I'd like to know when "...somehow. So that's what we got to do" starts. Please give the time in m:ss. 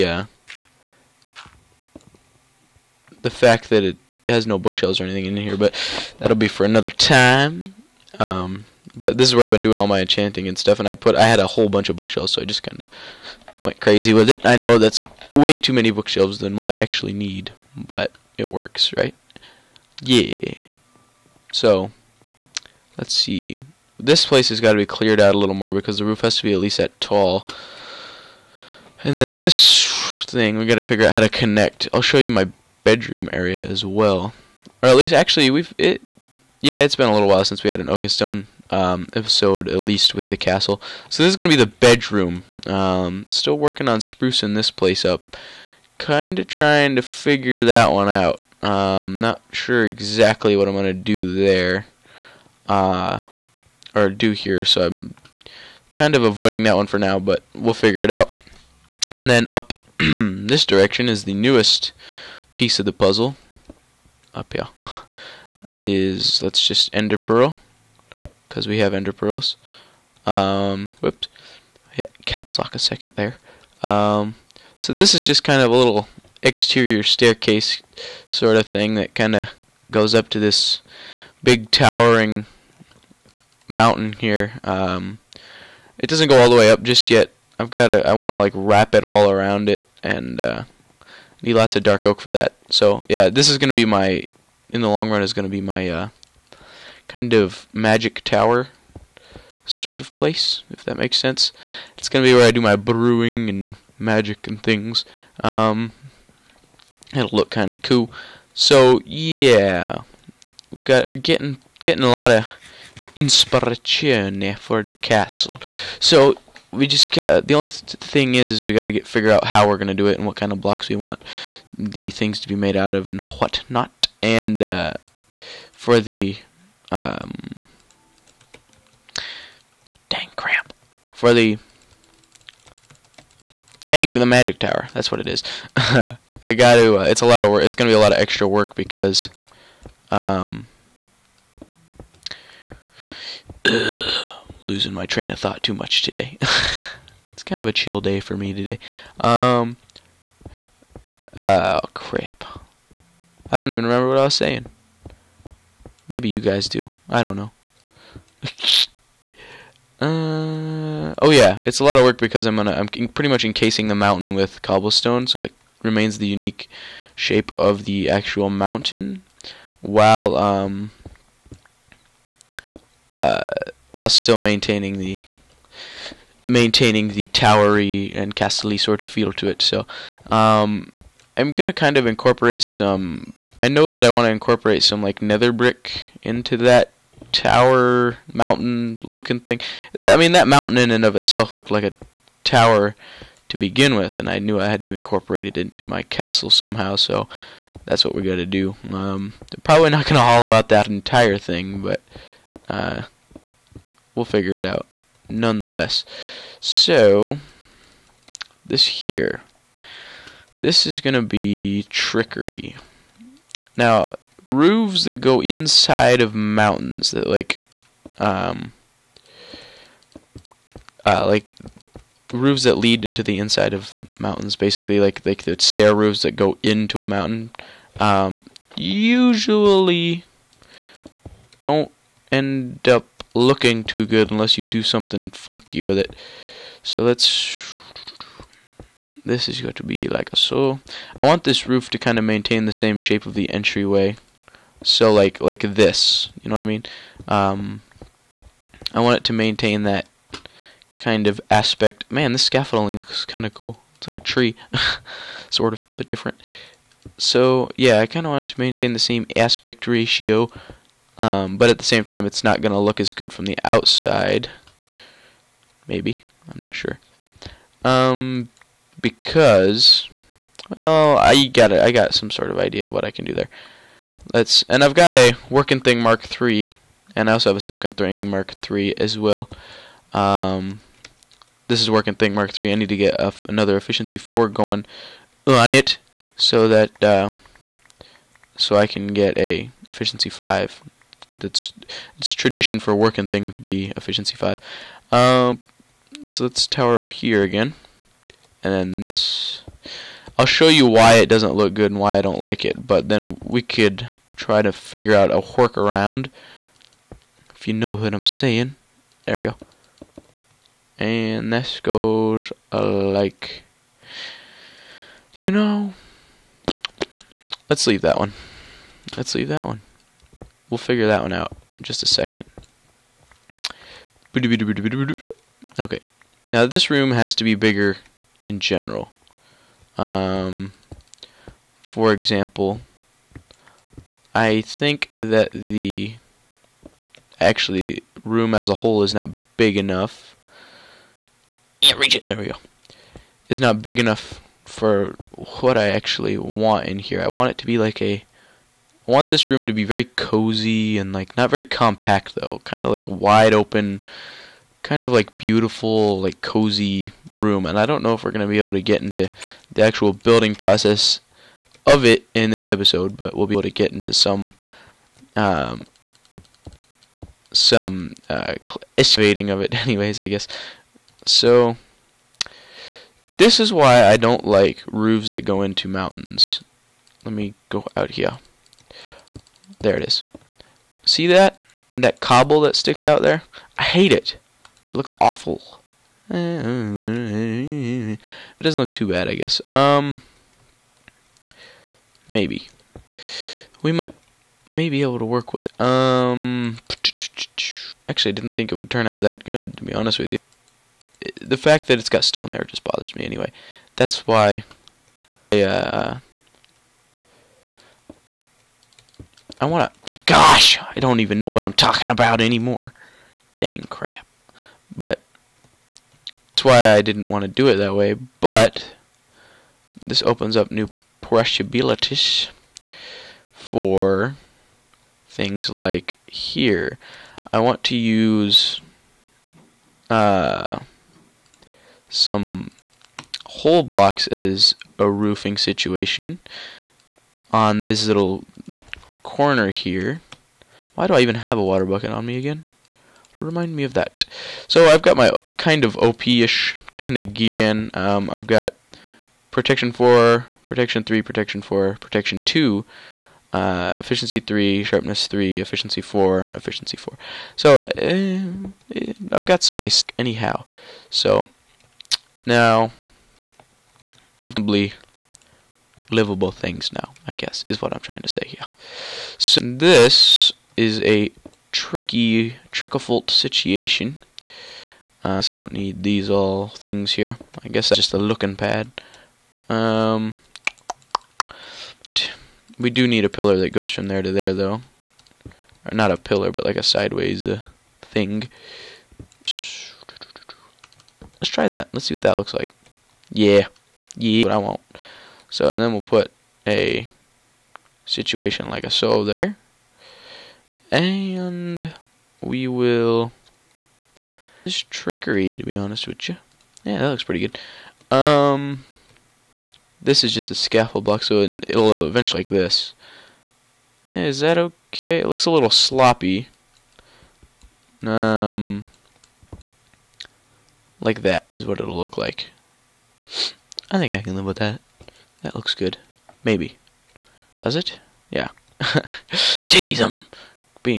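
3:16.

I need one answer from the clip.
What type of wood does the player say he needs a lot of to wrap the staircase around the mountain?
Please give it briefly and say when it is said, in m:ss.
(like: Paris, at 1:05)
dark oak, at 1:31.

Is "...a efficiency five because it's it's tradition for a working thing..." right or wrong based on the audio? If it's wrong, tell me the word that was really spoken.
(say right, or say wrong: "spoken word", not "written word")
right.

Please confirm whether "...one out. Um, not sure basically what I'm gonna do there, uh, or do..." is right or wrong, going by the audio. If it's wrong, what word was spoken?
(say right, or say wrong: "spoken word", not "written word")
wrong: "exactly", not "basically".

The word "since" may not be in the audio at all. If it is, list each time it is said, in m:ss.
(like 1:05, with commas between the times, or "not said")
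0:37.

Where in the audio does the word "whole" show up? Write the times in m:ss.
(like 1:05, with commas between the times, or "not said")
0:11, 5:38, 7:13.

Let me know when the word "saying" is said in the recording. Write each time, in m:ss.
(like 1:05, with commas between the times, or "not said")
2:34, 5:08.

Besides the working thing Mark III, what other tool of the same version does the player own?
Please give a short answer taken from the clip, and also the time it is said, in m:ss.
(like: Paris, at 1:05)
silken thing Mark III, at 4:37.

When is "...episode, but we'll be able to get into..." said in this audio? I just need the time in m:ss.
6:02.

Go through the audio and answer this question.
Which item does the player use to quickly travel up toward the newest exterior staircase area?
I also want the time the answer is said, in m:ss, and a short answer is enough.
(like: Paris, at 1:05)
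ender pearl, at 1:06.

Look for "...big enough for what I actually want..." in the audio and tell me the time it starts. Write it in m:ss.
5:43.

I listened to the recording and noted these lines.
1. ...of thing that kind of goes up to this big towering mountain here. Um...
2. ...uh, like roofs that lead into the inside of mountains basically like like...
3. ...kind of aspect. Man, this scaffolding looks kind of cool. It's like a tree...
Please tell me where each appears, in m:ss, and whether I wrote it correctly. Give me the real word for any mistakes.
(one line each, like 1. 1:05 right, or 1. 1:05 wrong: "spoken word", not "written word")
1. 1:18 right
2. 3:41 right
3. 4:10 right.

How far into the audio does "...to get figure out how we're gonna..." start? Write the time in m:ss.
1:58.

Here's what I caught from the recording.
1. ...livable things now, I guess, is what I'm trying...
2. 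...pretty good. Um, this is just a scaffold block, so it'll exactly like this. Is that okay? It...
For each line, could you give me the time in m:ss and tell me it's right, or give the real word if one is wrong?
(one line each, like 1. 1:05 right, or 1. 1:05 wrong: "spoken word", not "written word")
1. 7:46 right
2. 8:27 wrong: "eventually", not "exactly".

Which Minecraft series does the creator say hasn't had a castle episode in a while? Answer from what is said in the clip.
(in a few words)
Oakenstone.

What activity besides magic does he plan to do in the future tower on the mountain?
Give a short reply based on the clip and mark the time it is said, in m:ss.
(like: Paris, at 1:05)
brewing, at 1:42.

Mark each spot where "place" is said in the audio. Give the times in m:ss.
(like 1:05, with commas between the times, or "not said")
0:24, 0:44, 1:40.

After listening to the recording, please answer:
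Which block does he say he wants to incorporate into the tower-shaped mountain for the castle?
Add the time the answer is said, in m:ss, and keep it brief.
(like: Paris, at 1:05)
nether brick, at 3:05.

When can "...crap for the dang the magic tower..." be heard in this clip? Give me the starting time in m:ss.
2:10.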